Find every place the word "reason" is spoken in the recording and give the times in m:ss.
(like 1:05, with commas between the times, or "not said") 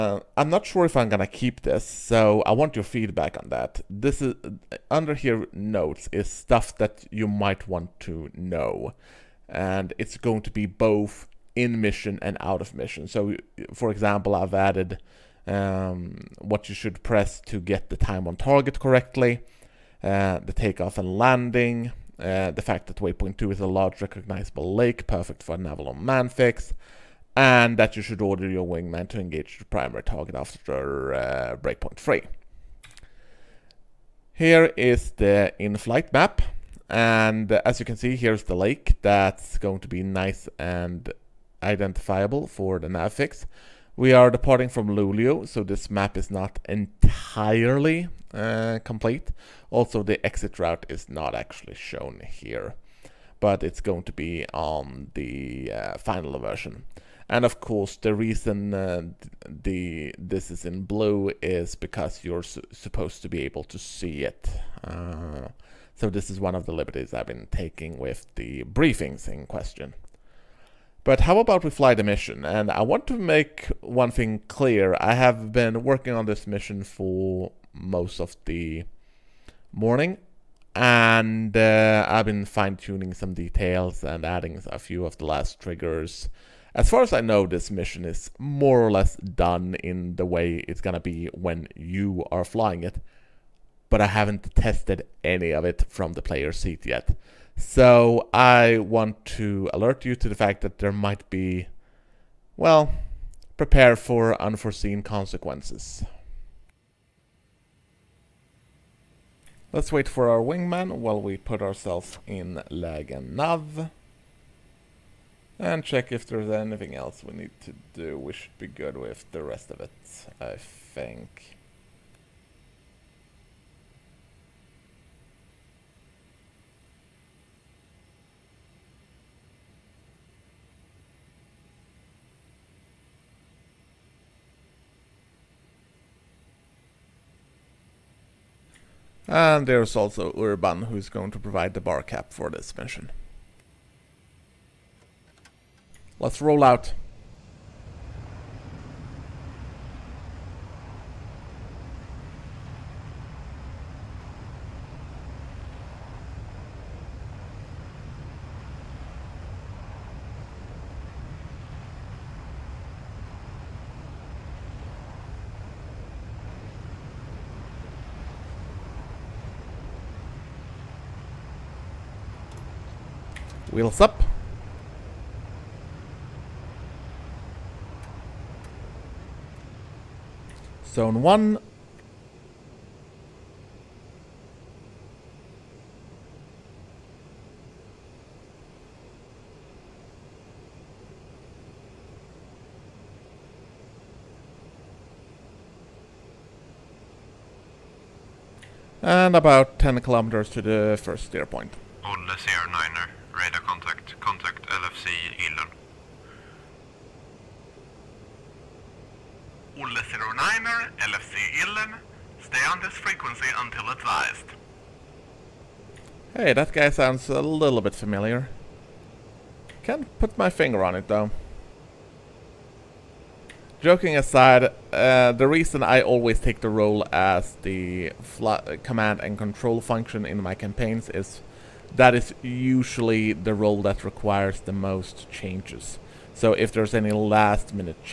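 0:58, 3:45.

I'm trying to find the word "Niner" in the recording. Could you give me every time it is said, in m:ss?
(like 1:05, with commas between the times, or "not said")
3:22.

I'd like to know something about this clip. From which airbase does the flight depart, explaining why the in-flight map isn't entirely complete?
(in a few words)
Luleå.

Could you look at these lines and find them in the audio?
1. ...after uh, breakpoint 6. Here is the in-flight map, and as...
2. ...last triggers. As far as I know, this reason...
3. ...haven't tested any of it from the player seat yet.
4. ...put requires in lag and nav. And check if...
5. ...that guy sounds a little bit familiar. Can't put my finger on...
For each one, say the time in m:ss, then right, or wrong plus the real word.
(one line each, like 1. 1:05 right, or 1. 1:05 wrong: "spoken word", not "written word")
1. 0:30 wrong: "3", not "6"
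2. 1:25 wrong: "mission", not "reason"
3. 1:34 right
4. 1:51 wrong: "ourselves", not "requires"
5. 3:36 right.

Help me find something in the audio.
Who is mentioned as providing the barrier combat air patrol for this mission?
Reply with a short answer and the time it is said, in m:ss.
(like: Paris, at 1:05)
Urban, at 2:20.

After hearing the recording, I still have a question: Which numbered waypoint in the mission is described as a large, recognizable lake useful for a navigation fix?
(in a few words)
Waypoint 2.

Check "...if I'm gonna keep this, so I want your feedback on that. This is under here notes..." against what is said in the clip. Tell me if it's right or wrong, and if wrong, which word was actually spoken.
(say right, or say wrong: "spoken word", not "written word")
right.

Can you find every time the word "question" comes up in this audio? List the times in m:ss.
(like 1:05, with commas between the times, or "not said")
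1:09.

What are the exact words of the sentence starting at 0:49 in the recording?
Also, the exit route is not actually shown here, but it's going to be on the uh, final version.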